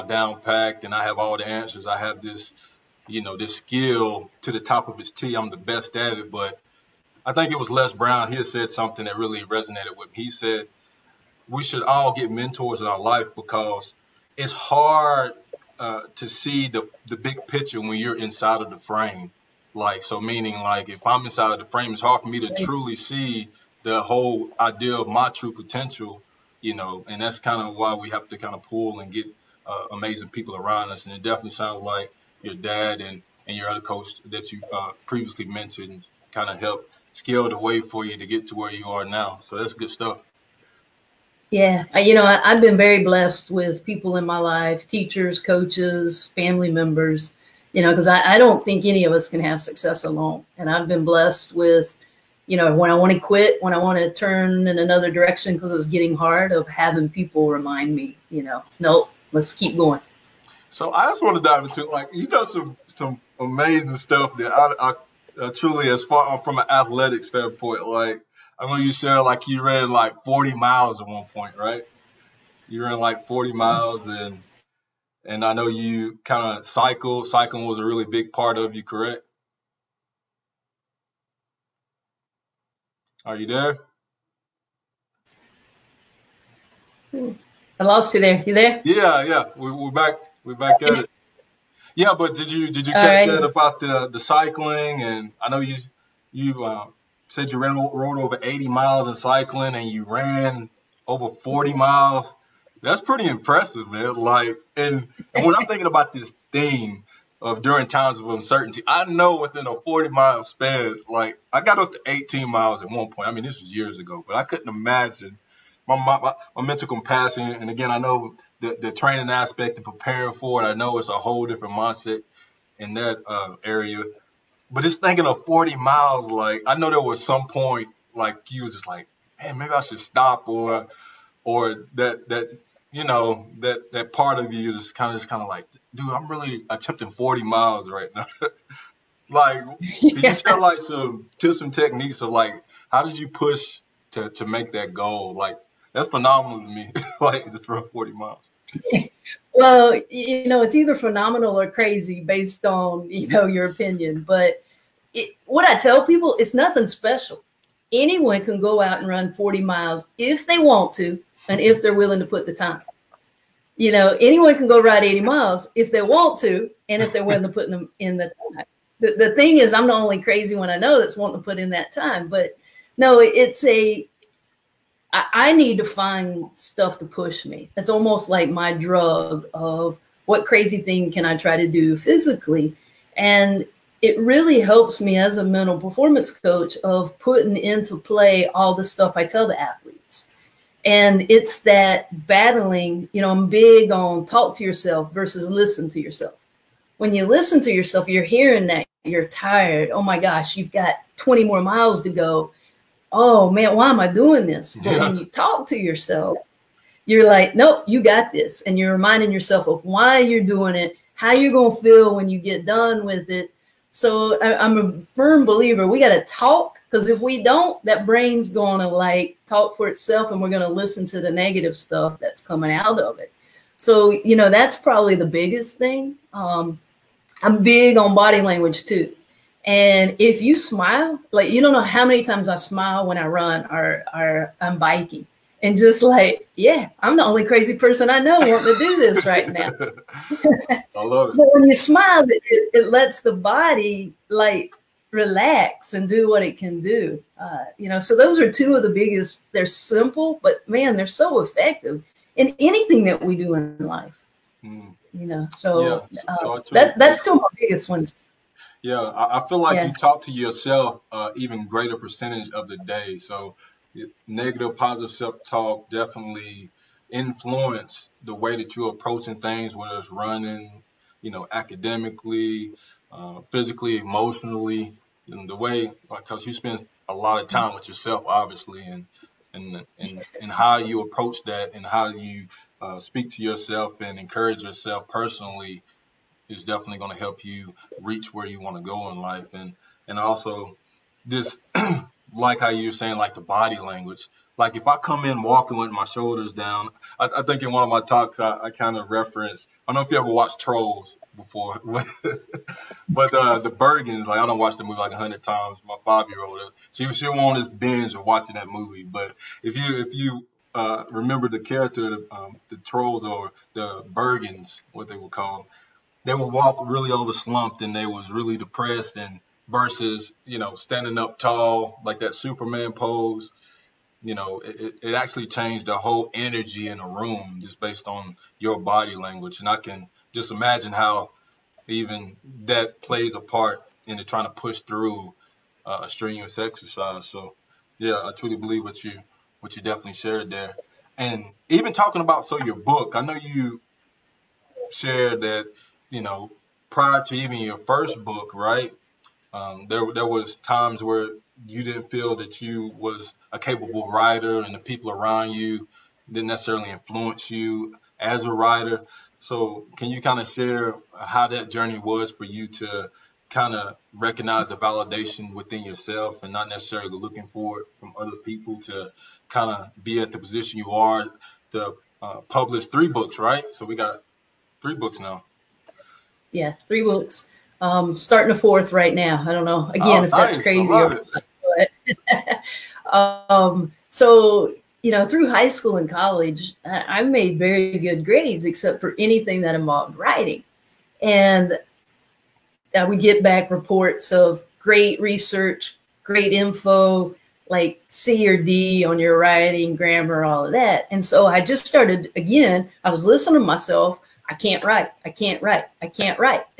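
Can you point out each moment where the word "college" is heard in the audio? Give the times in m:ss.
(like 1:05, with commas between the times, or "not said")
6:26.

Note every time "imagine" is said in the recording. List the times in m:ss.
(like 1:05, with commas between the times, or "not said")
1:54, 5:30.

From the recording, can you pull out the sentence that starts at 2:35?
It, what I tell people, it's nothing special.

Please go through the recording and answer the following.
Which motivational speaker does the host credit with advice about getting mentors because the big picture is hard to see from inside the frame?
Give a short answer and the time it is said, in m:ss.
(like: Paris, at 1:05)
Les Brown, at 0:07.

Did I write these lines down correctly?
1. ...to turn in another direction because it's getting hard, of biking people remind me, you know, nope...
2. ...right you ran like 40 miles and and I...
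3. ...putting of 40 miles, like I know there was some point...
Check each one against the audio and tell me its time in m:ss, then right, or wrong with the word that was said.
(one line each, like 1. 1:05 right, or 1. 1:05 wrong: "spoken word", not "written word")
1. 0:53 wrong: "having", not "biking"
2. 1:11 right
3. 2:05 wrong: "thinking", not "putting".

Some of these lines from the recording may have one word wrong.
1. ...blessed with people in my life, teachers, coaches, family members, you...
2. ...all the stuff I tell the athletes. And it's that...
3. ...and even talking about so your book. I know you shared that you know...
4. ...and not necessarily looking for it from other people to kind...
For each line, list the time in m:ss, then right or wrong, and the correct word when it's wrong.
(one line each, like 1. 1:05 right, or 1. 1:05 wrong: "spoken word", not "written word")
1. 0:43 right
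2. 3:08 right
3. 5:41 right
4. 6:06 right.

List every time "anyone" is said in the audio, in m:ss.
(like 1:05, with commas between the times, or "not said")
2:37, 2:44.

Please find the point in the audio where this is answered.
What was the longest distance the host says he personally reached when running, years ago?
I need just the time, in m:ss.
1:52.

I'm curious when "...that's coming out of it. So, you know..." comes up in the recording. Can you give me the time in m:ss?
3:42.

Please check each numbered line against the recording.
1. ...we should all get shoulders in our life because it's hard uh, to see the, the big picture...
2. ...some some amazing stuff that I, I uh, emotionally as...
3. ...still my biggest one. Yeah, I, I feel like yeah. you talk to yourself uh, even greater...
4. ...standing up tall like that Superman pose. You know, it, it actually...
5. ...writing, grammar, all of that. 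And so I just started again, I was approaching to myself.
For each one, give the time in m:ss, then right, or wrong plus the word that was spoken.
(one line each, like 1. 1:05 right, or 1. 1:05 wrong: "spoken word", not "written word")
1. 0:11 wrong: "mentors", not "shoulders"
2. 1:02 wrong: "truly", not "emotionally"
3. 4:17 right
4. 5:20 right
5. 6:39 wrong: "listening", not "approaching".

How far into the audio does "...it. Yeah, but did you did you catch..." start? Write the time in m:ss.
1:31.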